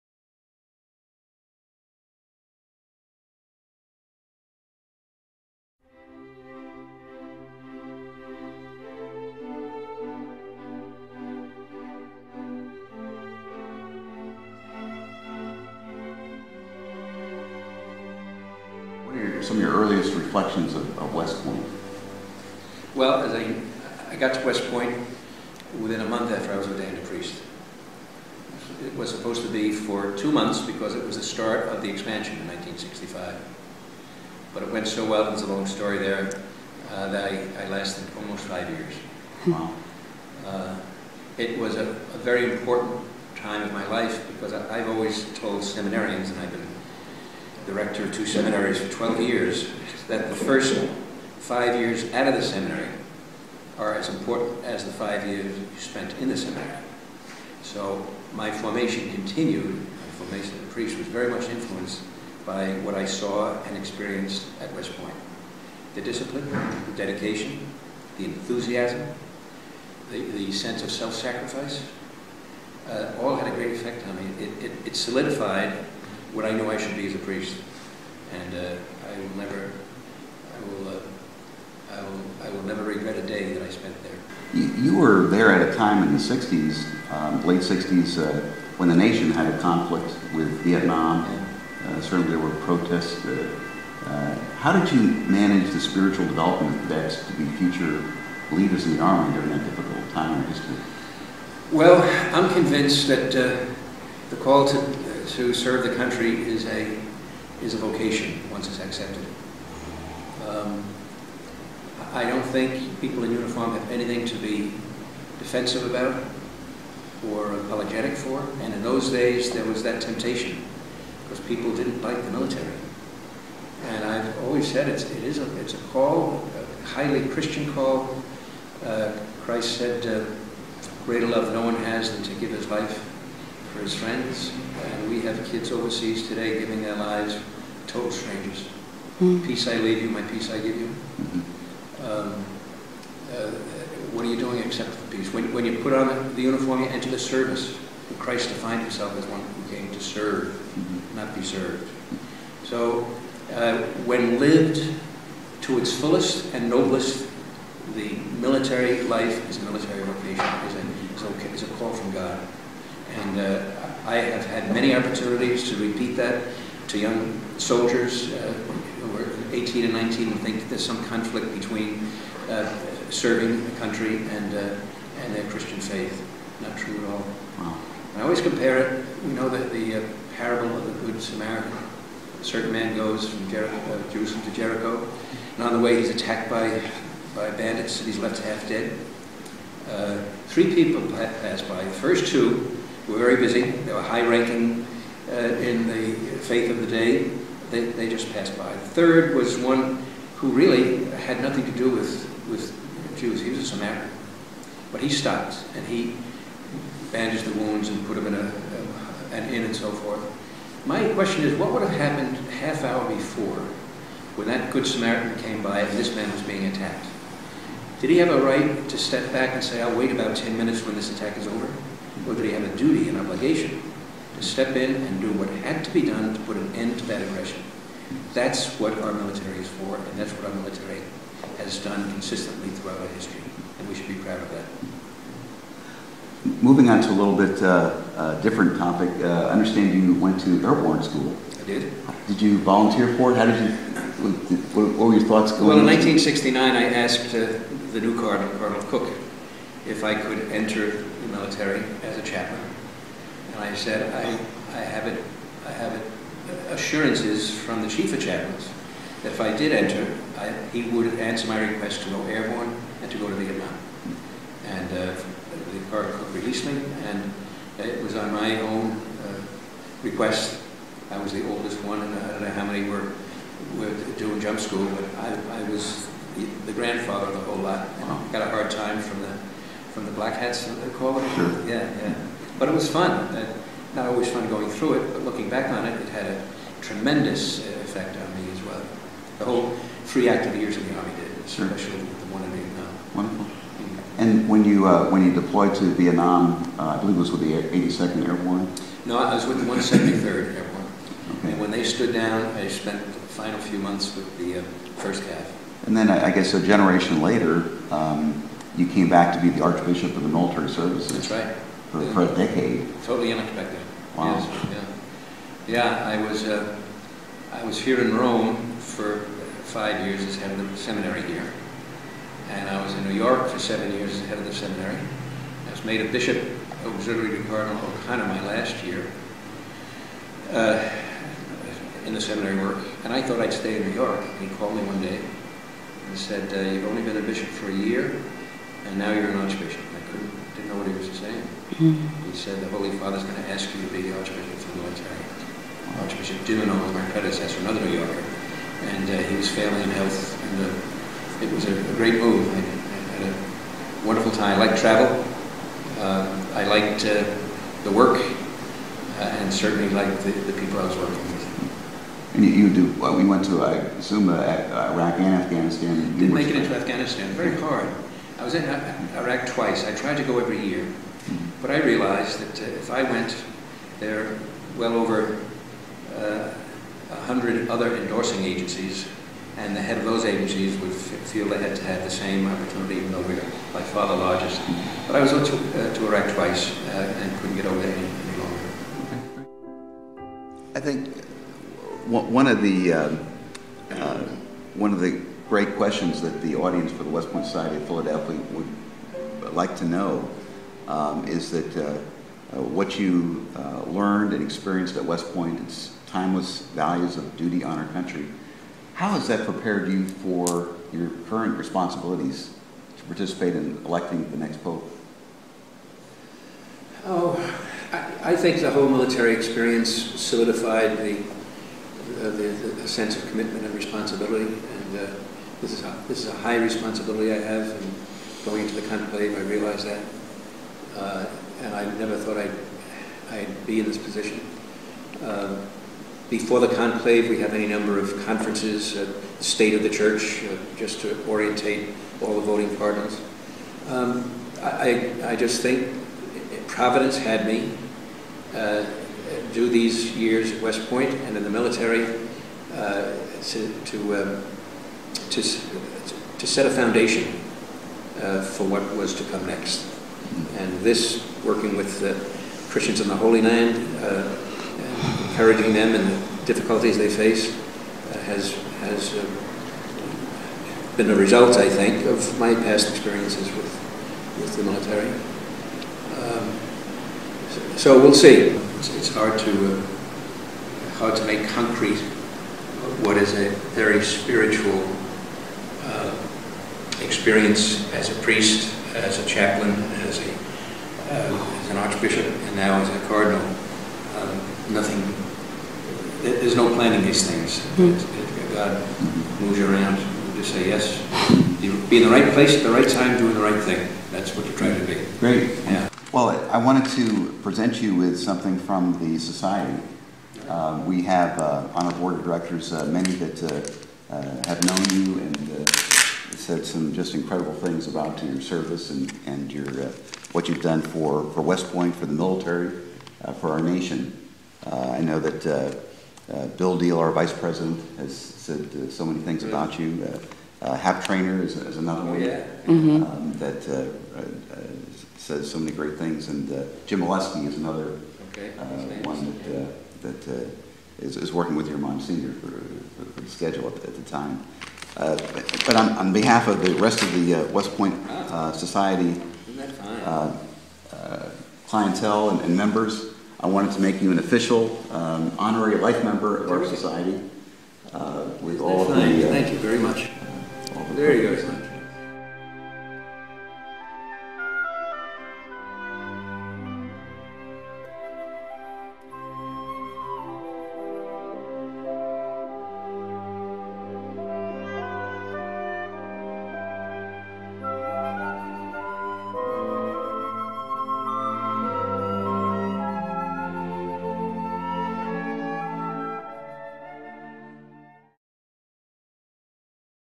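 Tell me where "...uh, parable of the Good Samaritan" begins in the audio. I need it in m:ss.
3:00.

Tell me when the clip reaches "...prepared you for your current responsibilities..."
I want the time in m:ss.
6:49.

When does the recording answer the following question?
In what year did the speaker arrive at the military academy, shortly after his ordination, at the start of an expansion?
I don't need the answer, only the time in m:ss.
0:32.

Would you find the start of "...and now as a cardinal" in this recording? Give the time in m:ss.
8:12.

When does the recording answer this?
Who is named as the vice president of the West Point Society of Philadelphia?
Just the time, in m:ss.
8:46.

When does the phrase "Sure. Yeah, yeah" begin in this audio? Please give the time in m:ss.
4:41.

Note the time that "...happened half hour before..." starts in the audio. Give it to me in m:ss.
3:31.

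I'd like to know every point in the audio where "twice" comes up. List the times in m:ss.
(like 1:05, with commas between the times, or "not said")
6:09, 6:26.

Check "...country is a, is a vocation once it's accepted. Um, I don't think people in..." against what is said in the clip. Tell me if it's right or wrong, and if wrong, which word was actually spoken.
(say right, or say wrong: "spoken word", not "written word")
right.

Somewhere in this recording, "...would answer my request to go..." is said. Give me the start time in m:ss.
4:20.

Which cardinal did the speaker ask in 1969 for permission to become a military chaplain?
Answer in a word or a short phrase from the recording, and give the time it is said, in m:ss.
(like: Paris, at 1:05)
Cardinal Cooke, at 4:08.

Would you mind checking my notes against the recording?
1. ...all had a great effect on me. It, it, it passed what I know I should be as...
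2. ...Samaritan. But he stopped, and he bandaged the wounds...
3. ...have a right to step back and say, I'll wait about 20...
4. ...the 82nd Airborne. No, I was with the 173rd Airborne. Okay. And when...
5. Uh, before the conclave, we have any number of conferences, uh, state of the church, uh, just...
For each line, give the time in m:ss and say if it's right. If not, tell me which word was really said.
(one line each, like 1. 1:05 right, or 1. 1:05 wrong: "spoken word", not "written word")
1. 1:13 wrong: "solidified", not "passed"
2. 3:23 right
3. 3:38 wrong: "10", not "20"
4. 4:57 right
5. 7:15 right.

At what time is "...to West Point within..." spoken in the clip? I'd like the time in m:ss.
0:24.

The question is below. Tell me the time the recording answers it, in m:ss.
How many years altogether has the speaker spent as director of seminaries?
0:48.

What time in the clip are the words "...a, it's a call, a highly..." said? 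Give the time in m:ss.
2:05.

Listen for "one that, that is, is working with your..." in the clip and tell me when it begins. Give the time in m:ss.
8:59.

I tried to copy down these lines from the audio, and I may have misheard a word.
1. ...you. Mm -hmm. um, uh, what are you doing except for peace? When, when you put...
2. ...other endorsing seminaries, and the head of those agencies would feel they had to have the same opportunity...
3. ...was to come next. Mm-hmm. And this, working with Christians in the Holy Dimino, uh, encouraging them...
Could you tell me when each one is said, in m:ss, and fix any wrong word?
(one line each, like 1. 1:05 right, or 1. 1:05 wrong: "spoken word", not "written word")
1. 2:20 right
2. 6:17 wrong: "agencies", not "seminaries"
3. 7:38 wrong: "Land", not "Dimino".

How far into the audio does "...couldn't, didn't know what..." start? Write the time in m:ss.
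5:40.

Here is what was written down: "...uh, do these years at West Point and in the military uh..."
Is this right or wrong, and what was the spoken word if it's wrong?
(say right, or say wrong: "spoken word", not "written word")
right.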